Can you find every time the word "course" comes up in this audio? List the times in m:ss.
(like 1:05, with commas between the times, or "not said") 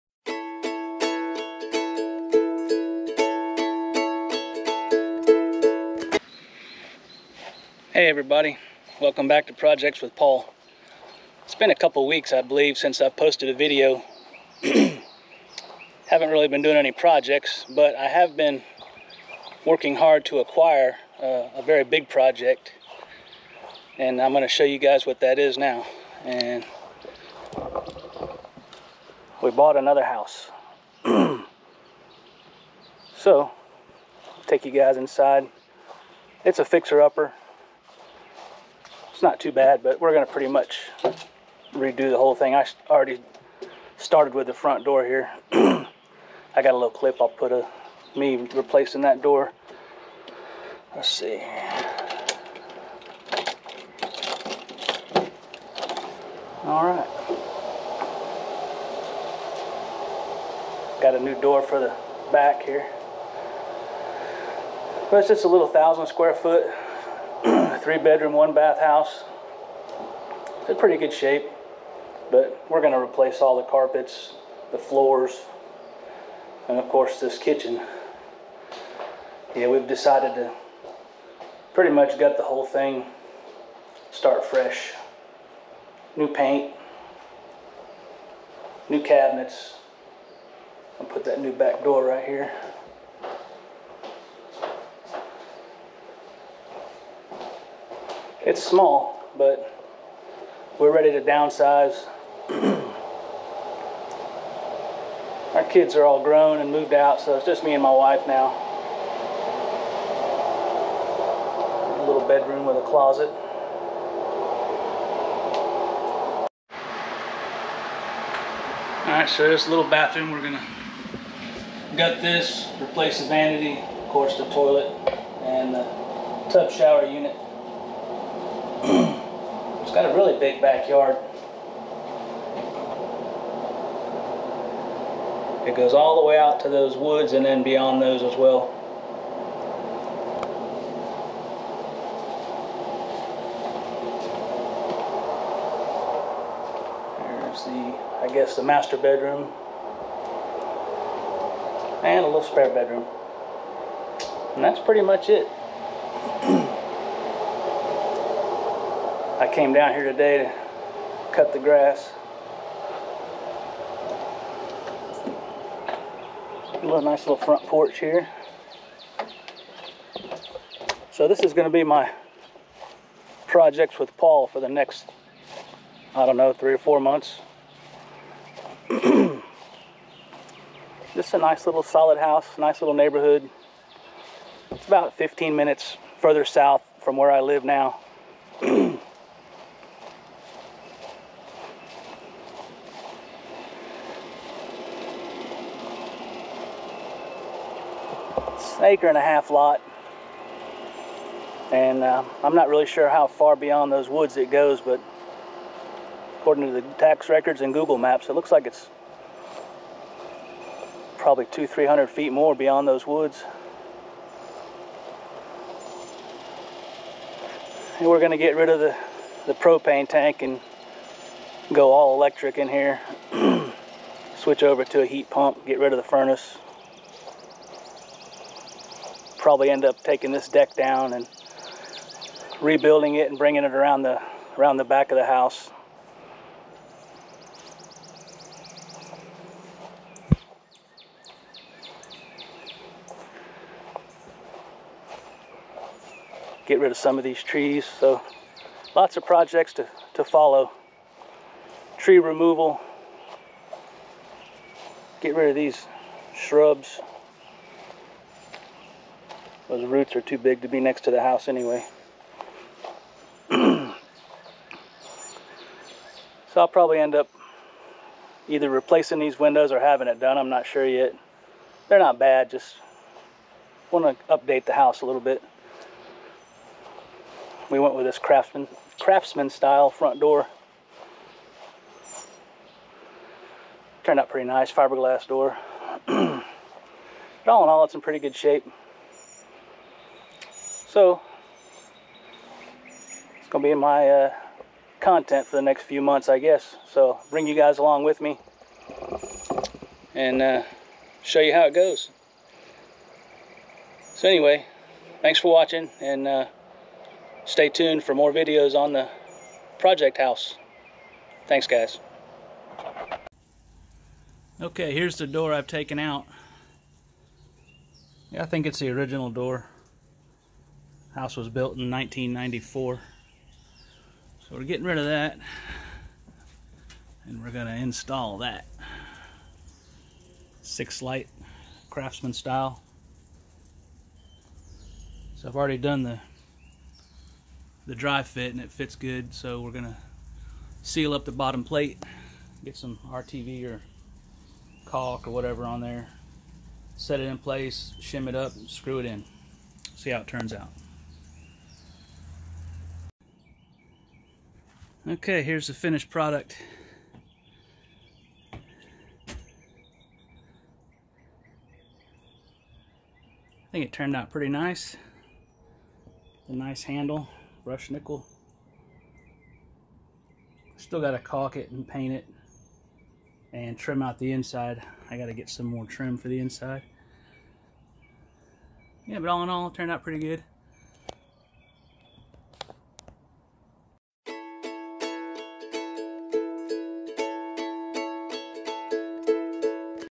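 1:16, 2:04.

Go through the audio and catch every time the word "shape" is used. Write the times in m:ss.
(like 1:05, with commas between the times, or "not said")
1:11, 4:48.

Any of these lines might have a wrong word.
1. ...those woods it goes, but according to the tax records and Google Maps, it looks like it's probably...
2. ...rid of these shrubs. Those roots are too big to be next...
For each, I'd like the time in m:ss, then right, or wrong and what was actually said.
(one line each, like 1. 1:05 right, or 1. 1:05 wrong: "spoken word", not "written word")
1. 3:23 right
2. 4:15 right.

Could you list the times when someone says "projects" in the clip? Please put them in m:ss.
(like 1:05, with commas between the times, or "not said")
0:09, 0:16, 0:22, 2:53, 4:09, 5:09.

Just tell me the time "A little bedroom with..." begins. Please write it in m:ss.
1:52.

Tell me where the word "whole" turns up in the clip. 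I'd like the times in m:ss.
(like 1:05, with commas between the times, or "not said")
0:42, 1:22.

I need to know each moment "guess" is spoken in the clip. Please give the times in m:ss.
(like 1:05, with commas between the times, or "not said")
2:28, 4:56.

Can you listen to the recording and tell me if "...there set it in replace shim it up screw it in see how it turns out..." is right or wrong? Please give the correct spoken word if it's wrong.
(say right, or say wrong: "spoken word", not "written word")
wrong: "place", not "replace".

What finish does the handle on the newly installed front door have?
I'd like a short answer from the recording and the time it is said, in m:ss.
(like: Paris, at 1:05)
Brushed nickel, at 6:07.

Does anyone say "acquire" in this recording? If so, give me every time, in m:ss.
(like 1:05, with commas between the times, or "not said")
0:20.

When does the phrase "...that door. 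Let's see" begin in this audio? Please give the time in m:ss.
0:49.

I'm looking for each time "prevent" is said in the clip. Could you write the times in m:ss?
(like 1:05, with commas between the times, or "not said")
not said.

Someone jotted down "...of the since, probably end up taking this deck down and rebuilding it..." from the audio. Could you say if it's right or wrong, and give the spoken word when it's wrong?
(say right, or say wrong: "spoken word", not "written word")
wrong: "furnace", not "since".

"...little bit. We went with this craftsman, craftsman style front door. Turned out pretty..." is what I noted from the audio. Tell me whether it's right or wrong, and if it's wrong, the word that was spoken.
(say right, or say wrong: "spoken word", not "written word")
right.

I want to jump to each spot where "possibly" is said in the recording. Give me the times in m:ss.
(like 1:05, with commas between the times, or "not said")
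not said.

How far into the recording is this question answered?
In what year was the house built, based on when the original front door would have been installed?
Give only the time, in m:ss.
5:21.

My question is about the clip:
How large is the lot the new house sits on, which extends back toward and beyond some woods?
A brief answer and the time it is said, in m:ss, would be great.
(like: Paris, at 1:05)
An acre and a half, at 3:18.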